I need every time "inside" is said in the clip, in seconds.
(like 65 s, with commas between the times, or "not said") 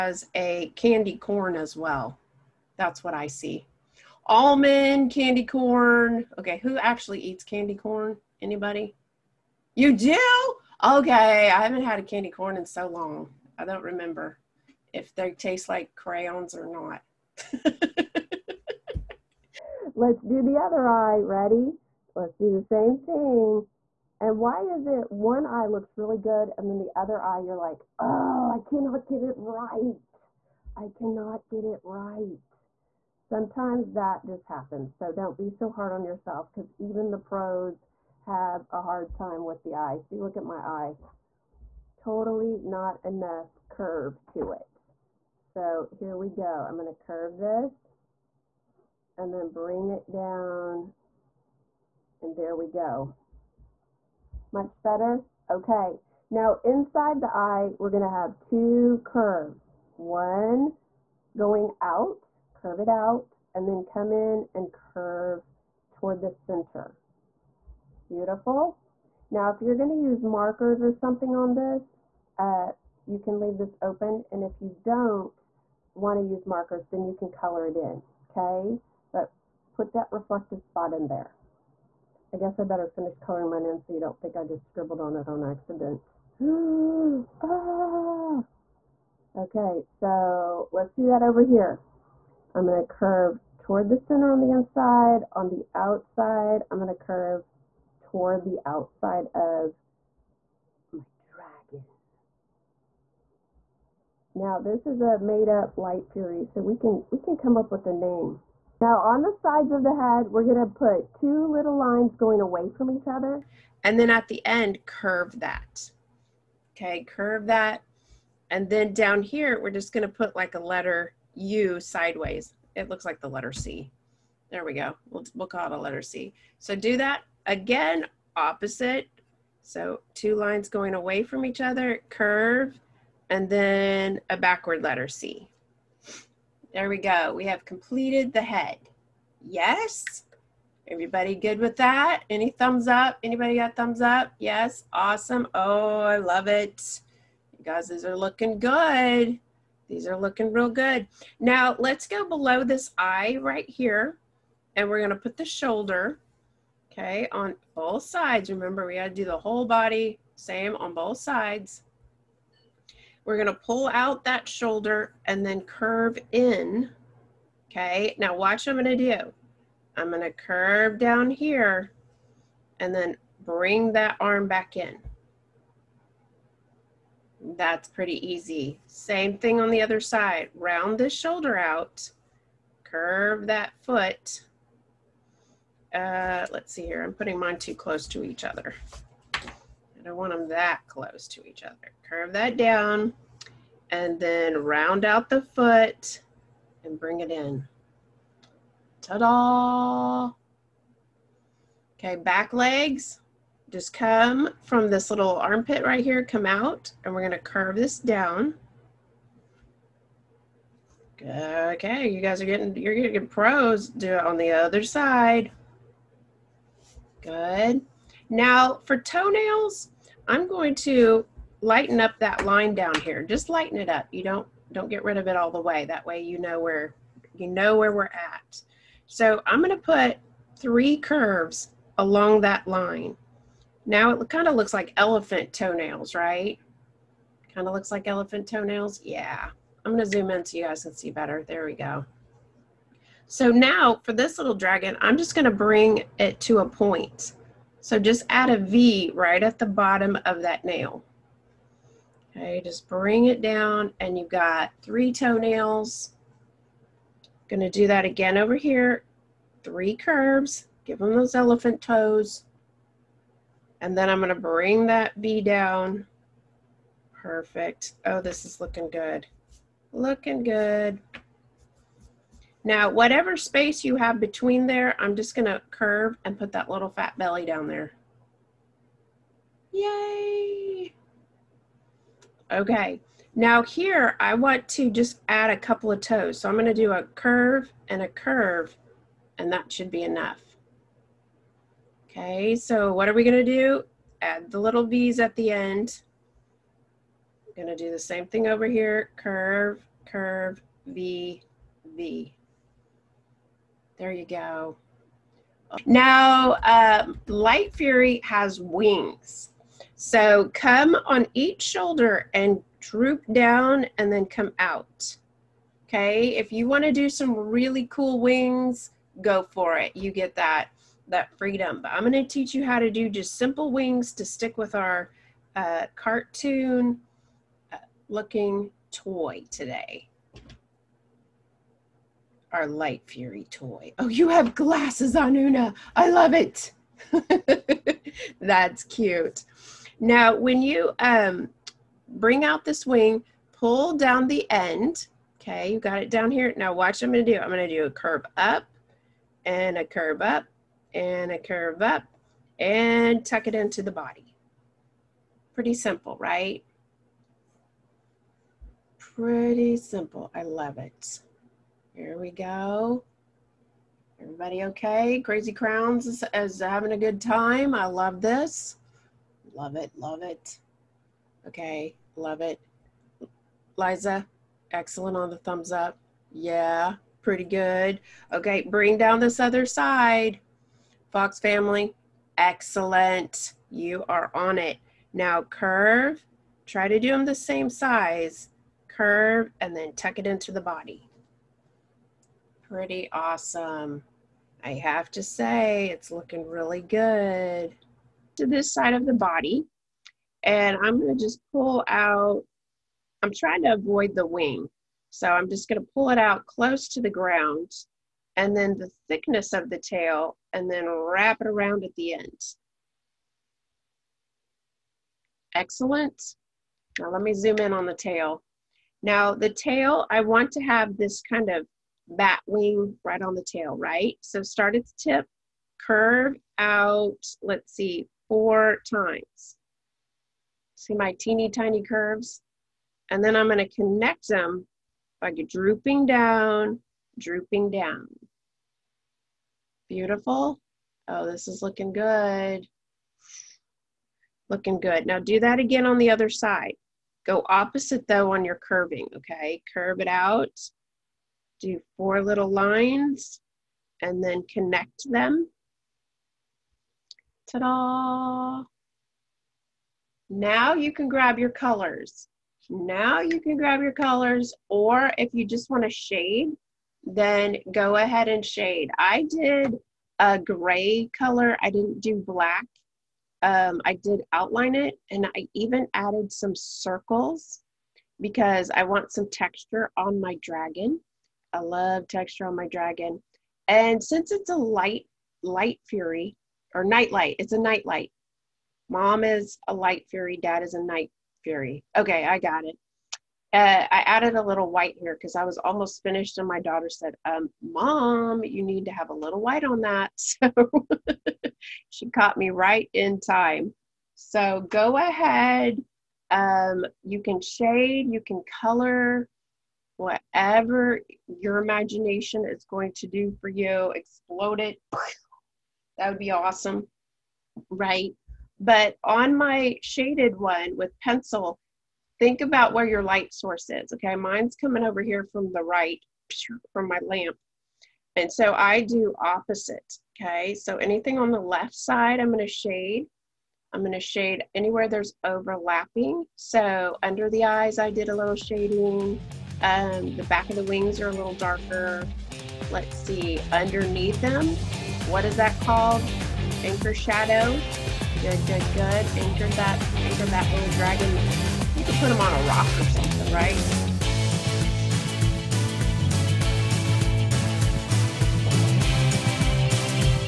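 56 s, 94 s.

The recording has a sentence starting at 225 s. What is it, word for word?
That way you know where you know where we're at.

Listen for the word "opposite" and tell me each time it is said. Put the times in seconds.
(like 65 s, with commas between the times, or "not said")
128 s, 447 s, 529 s.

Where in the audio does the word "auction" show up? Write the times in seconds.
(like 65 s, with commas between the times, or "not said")
not said.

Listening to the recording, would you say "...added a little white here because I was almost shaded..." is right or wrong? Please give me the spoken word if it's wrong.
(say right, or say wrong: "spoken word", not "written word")
wrong: "finished", not "shaded".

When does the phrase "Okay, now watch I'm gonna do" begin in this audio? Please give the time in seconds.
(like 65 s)
167 s.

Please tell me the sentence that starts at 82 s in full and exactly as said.
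I guess I better finish coloring mine in so you don't think I just scribbled on it on accident.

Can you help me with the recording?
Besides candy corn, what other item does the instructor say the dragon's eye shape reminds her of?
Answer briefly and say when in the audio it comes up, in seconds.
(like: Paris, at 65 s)
Almond, at 4 s.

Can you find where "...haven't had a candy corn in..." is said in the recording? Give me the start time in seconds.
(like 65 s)
11 s.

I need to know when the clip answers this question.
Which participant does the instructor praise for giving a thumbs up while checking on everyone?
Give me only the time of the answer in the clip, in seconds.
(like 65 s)
373 s.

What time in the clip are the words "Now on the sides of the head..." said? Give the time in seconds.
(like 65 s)
108 s.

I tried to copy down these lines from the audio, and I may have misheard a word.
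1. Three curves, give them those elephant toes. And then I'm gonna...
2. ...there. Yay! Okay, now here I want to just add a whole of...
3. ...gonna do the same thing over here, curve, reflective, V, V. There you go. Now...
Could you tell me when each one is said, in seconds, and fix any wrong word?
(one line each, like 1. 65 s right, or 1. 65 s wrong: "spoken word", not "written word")
1. 259 s right
2. 277 s wrong: "couple", not "whole"
3. 297 s wrong: "curve", not "reflective".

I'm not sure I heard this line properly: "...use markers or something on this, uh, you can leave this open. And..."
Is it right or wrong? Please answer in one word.
right.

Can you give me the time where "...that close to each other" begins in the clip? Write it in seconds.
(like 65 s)
190 s.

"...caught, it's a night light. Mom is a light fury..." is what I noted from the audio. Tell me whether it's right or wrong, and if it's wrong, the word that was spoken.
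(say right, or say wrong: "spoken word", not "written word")
wrong: "light", not "caught".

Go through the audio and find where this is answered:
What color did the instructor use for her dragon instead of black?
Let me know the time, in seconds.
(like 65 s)
470 s.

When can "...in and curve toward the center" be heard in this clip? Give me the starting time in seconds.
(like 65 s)
64 s.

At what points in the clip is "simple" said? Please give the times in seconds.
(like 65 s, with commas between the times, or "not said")
323 s, 355 s, 359 s.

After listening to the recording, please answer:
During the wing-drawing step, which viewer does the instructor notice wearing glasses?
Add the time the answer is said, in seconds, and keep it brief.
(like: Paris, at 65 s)
Una, at 335 s.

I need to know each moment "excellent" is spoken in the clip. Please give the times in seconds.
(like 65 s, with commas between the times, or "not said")
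374 s, 382 s, 415 s.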